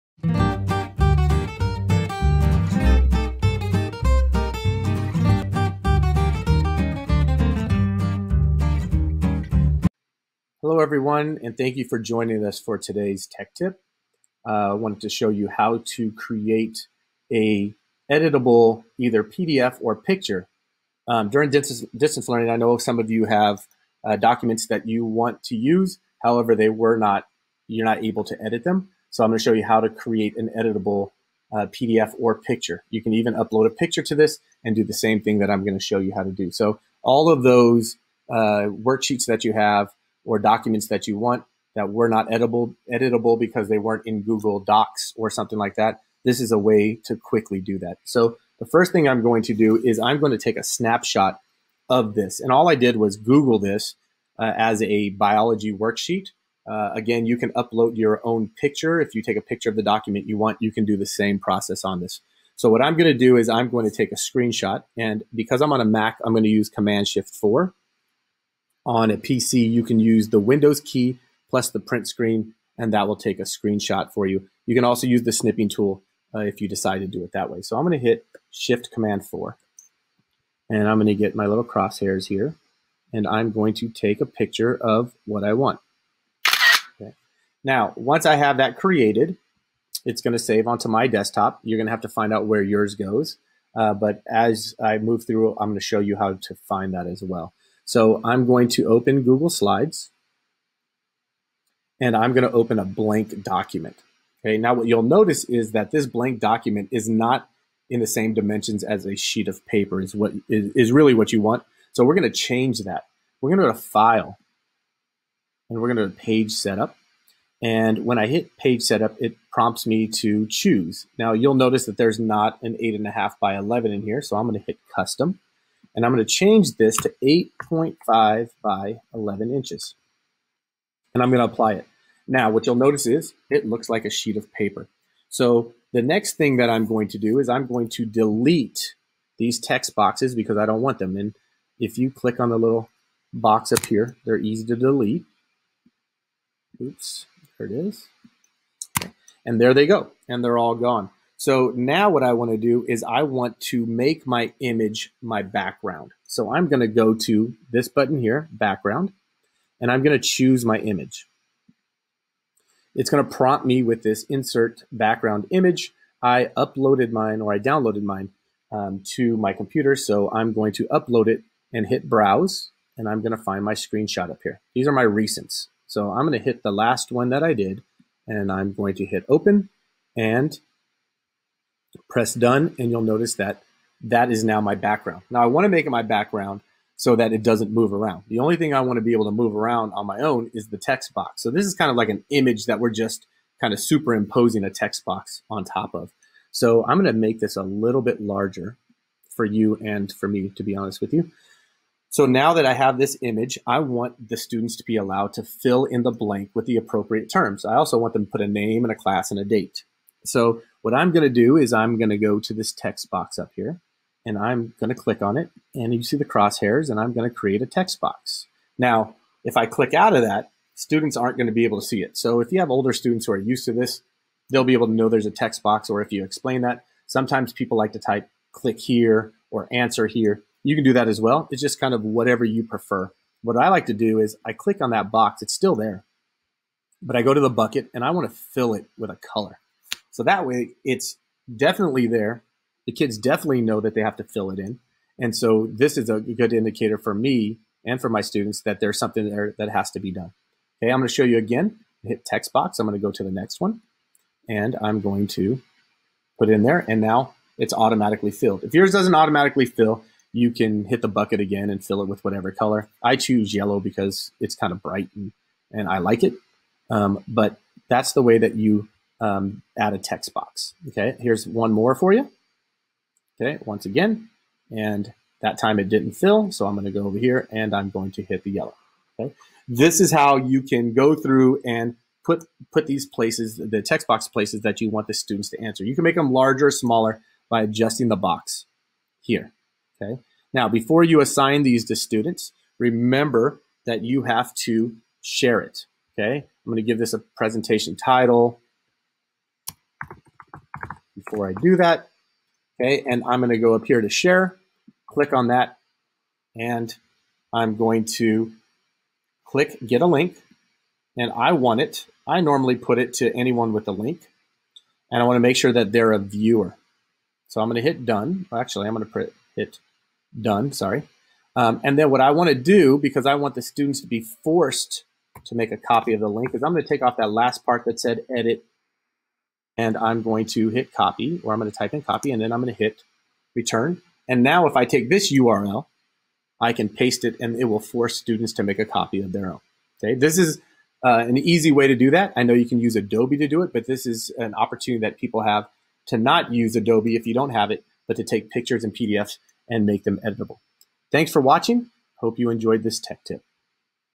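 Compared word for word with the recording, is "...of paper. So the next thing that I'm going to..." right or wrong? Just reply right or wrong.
right.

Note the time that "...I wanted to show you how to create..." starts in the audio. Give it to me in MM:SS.
00:14.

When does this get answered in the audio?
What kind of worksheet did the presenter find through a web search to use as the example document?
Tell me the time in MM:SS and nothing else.
00:55.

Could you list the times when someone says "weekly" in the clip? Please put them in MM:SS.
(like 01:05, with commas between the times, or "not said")
not said.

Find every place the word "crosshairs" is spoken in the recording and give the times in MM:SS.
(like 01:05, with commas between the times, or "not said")
01:21, 03:36.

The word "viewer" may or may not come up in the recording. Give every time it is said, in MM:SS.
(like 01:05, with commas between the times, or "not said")
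05:16.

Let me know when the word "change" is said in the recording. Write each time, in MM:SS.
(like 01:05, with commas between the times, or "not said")
01:52, 02:06.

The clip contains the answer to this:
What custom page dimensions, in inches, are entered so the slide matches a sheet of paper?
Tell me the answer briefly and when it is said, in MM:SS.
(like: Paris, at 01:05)
8.5 by 11, at 02:07.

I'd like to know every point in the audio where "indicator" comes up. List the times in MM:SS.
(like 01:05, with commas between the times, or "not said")
04:06.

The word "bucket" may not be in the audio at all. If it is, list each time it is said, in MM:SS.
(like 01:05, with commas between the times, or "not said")
03:57, 04:21.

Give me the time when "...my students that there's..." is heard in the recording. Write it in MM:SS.
04:08.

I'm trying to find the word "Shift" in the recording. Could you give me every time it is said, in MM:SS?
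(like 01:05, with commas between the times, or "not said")
01:07, 01:18.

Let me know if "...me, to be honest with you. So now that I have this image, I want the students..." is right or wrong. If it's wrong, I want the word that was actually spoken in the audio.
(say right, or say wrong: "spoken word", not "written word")
right.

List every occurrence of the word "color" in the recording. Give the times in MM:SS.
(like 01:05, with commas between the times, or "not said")
03:59, 04:22.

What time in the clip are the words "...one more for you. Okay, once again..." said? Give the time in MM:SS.
04:31.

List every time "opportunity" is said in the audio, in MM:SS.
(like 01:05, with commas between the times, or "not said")
05:44.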